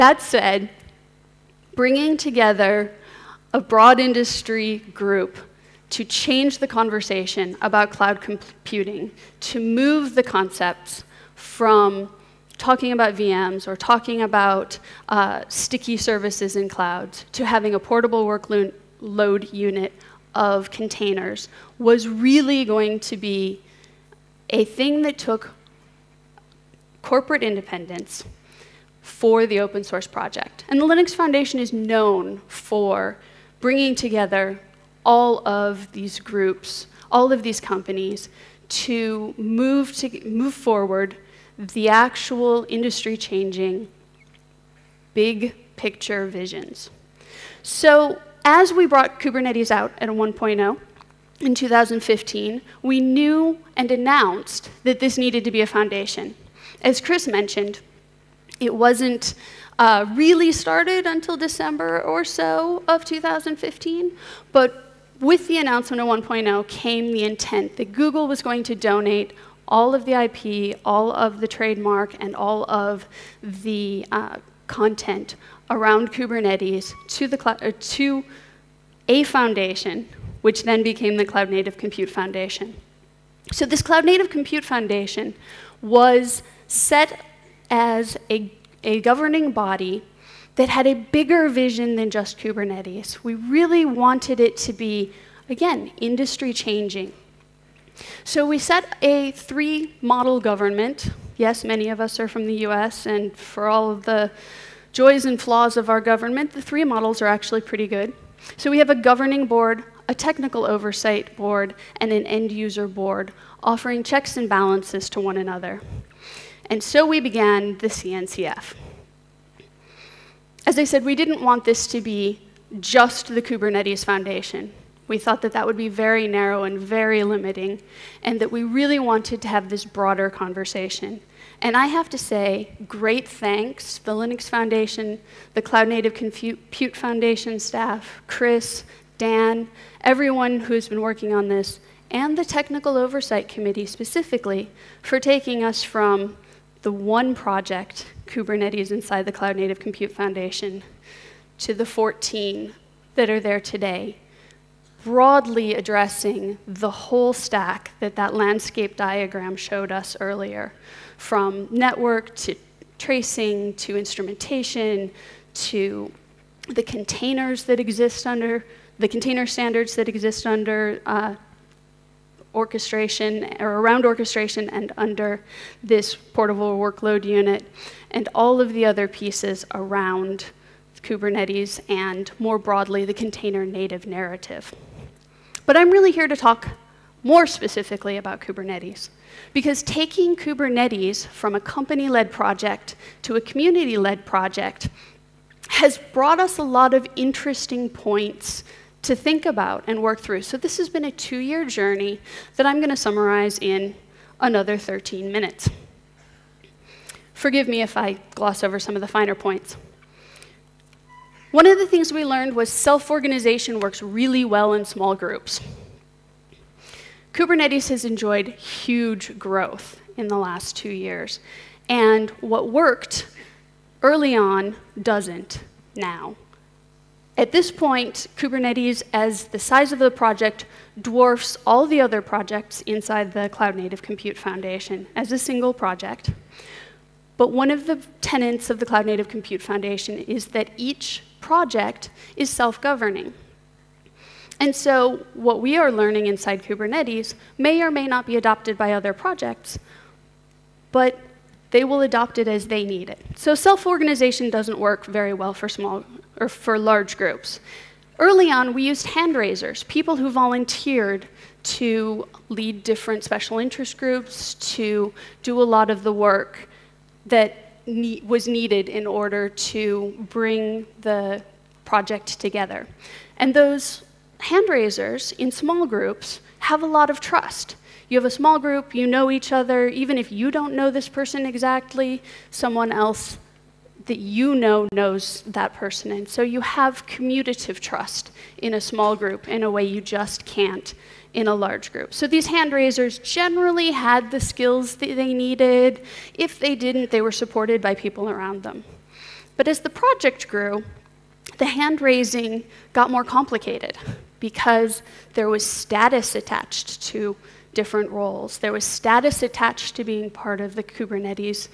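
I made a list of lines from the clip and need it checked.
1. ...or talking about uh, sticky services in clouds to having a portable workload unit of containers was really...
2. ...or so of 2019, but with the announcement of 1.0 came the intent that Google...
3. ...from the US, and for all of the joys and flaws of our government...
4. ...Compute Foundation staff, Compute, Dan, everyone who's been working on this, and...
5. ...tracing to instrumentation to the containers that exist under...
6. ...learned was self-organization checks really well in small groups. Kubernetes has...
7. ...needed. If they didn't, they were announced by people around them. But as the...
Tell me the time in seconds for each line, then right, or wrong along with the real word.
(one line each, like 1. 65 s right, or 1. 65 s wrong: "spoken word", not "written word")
1. 13 s right
2. 62 s wrong: "2015", not "2019"
3. 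102 s right
4. 136 s wrong: "Chris", not "Compute"
5. 162 s right
6. 212 s wrong: "works", not "checks"
7. 295 s wrong: "supported", not "announced".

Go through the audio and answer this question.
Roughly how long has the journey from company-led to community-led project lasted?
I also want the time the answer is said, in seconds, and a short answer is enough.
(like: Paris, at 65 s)
two years, at 201 s.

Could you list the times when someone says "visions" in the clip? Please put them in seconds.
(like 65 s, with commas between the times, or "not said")
46 s, 91 s.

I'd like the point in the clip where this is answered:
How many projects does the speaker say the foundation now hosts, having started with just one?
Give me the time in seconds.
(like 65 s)
151 s.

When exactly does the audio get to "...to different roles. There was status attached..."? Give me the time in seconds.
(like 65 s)
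307 s.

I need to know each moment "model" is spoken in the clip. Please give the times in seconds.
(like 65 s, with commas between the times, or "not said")
100 s, 106 s.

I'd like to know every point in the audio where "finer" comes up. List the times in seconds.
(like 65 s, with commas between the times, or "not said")
209 s.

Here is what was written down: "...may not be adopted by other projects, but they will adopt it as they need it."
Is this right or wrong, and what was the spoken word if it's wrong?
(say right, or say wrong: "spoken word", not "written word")
right.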